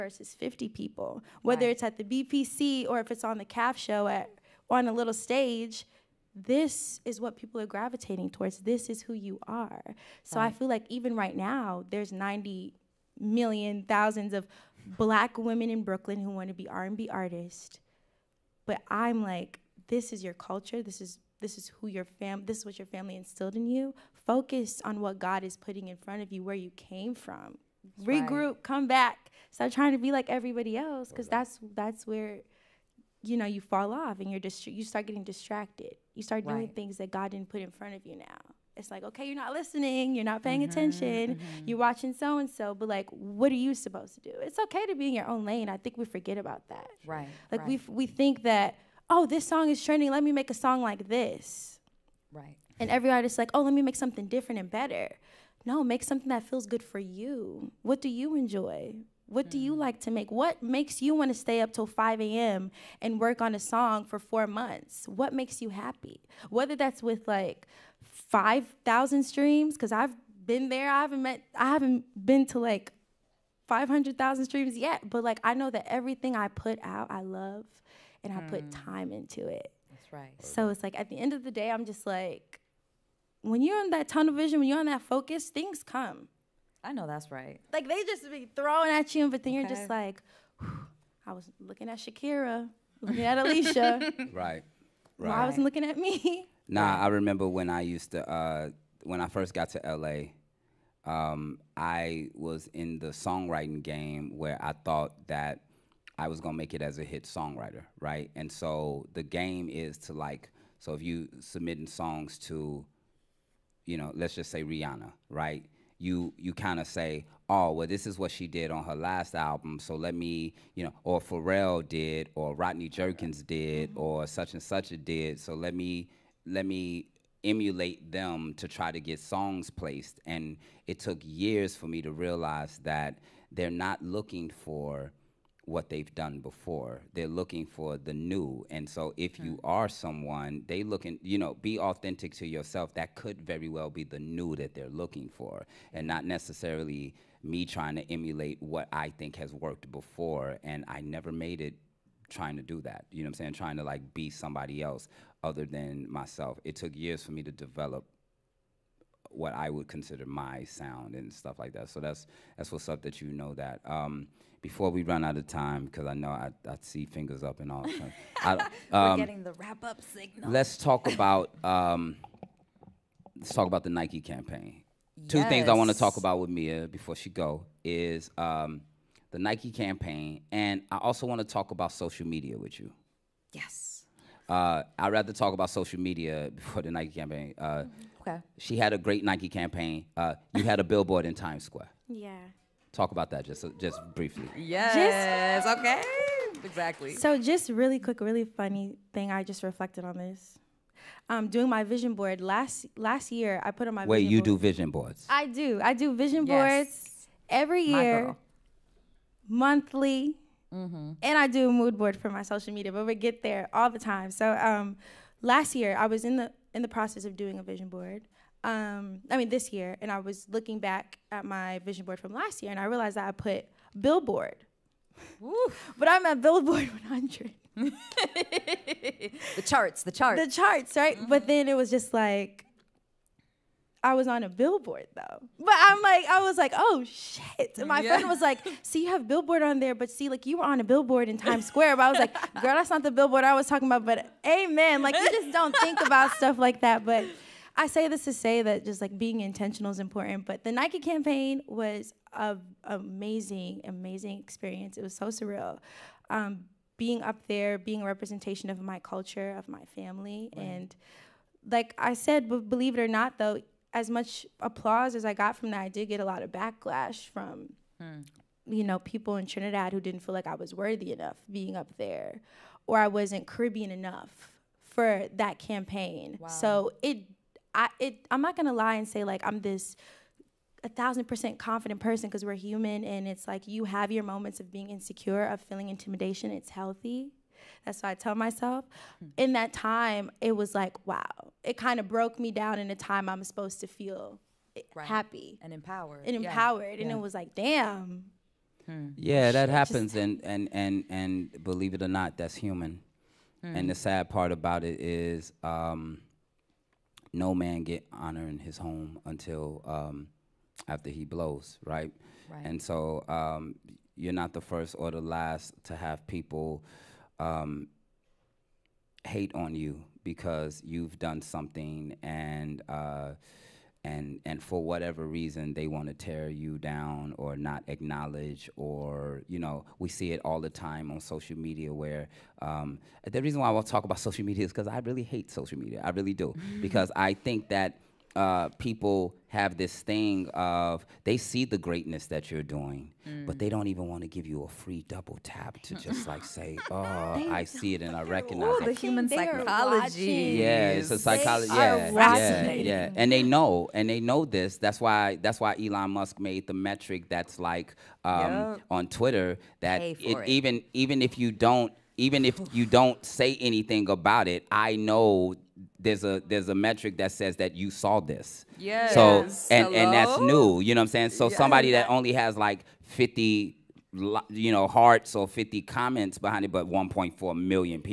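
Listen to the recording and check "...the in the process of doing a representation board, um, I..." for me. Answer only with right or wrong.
wrong.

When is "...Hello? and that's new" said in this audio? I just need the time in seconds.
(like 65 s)
369 s.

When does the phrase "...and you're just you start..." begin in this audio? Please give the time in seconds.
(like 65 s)
34 s.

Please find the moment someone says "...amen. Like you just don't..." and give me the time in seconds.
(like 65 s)
244 s.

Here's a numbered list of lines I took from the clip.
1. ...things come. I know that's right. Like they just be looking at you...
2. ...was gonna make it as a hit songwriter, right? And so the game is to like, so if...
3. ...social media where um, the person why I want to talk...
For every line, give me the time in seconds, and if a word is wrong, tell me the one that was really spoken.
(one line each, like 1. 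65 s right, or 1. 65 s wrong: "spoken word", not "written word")
1. 85 s wrong: "throwing", not "looking"
2. 106 s right
3. 331 s wrong: "reason", not "person".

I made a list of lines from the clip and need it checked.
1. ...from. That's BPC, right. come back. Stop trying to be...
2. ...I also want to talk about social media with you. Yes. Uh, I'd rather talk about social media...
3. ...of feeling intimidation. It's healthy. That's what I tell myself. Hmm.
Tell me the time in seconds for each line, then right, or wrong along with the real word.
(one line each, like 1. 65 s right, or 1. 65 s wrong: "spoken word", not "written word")
1. 27 s wrong: "Regroup", not "BPC"
2. 180 s right
3. 285 s right.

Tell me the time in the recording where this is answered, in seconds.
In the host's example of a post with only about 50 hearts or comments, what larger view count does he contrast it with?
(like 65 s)
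376 s.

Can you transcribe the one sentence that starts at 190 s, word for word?
Uh, you had a billboard in Times Square.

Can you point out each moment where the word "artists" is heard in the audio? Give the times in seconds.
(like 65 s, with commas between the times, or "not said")
17 s, 53 s.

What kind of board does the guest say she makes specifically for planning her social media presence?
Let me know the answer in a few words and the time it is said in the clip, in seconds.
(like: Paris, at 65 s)
Mood board, at 211 s.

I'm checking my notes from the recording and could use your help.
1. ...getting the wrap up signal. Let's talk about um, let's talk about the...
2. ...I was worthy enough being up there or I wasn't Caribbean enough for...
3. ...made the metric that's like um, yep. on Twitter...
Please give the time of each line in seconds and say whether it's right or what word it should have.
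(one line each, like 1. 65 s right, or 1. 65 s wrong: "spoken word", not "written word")
1. 169 s right
2. 270 s right
3. 356 s right.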